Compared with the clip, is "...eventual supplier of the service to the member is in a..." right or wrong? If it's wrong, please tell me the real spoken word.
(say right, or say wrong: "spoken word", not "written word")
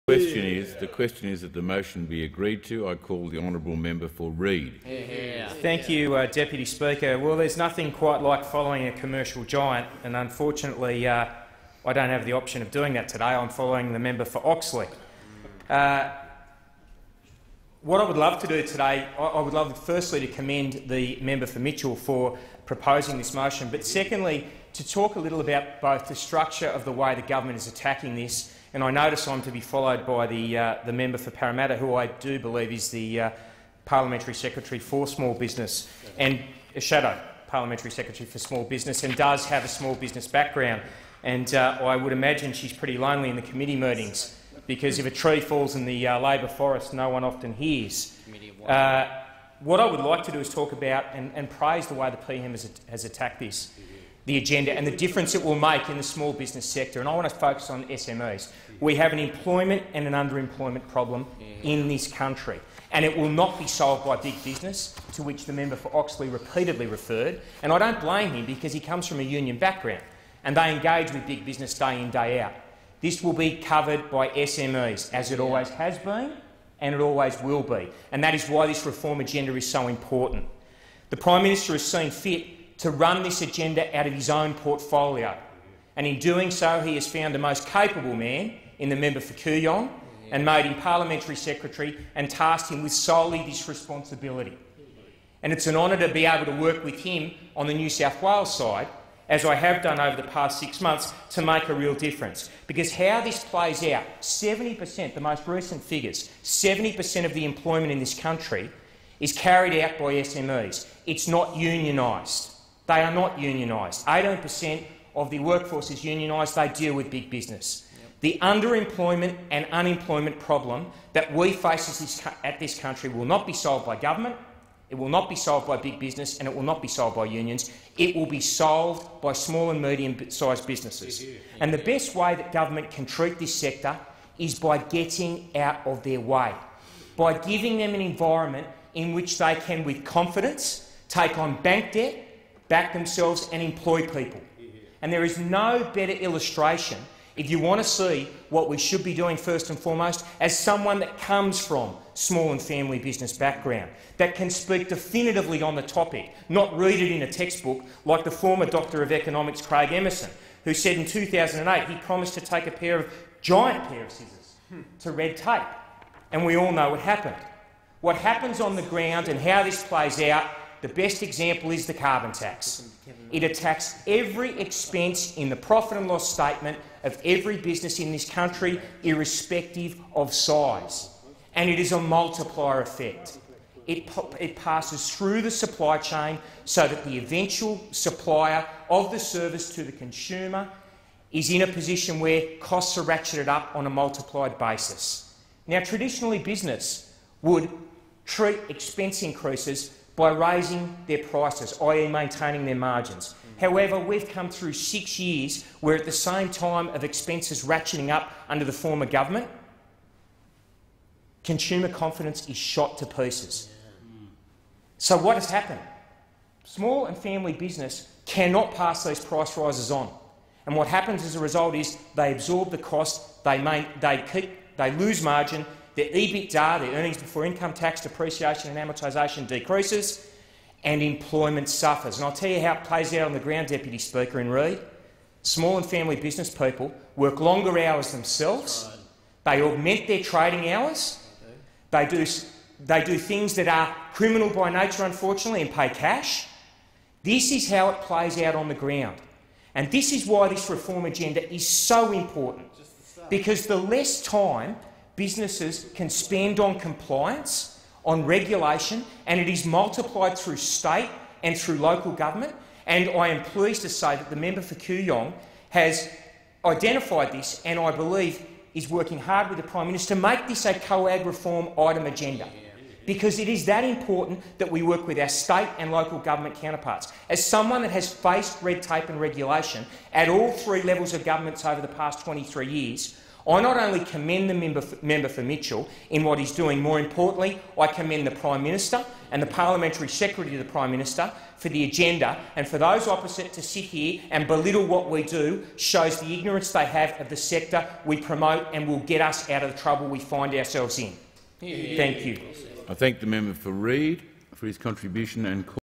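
wrong: "consumer", not "member".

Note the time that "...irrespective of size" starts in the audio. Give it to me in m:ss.
2:59.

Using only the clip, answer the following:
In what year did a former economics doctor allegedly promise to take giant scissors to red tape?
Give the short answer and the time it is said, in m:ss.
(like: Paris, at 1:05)
2008, at 2:41.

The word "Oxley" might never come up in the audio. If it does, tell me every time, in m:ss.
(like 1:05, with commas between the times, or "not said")
0:14, 1:05.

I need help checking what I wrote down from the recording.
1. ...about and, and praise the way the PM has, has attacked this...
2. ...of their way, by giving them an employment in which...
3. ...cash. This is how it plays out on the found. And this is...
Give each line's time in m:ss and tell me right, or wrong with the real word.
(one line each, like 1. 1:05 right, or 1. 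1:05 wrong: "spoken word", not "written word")
1. 0:50 right
2. 2:15 wrong: "environment", not "employment"
3. 4:05 wrong: "ground", not "found".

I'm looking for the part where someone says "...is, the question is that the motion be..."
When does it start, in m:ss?
0:00.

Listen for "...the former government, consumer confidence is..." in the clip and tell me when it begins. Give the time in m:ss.
3:28.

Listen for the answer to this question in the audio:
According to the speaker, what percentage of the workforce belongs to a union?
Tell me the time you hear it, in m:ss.
1:54.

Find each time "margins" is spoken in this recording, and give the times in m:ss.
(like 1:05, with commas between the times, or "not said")
3:22, 3:45.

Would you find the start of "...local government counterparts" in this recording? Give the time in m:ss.
4:35.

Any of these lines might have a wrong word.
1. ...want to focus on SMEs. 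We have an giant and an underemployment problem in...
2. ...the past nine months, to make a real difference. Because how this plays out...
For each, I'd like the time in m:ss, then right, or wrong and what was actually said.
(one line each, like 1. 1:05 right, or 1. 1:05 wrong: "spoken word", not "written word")
1. 0:57 wrong: "employment", not "giant"
2. 1:40 wrong: "six", not "nine".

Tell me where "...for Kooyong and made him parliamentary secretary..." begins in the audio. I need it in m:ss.
1:29.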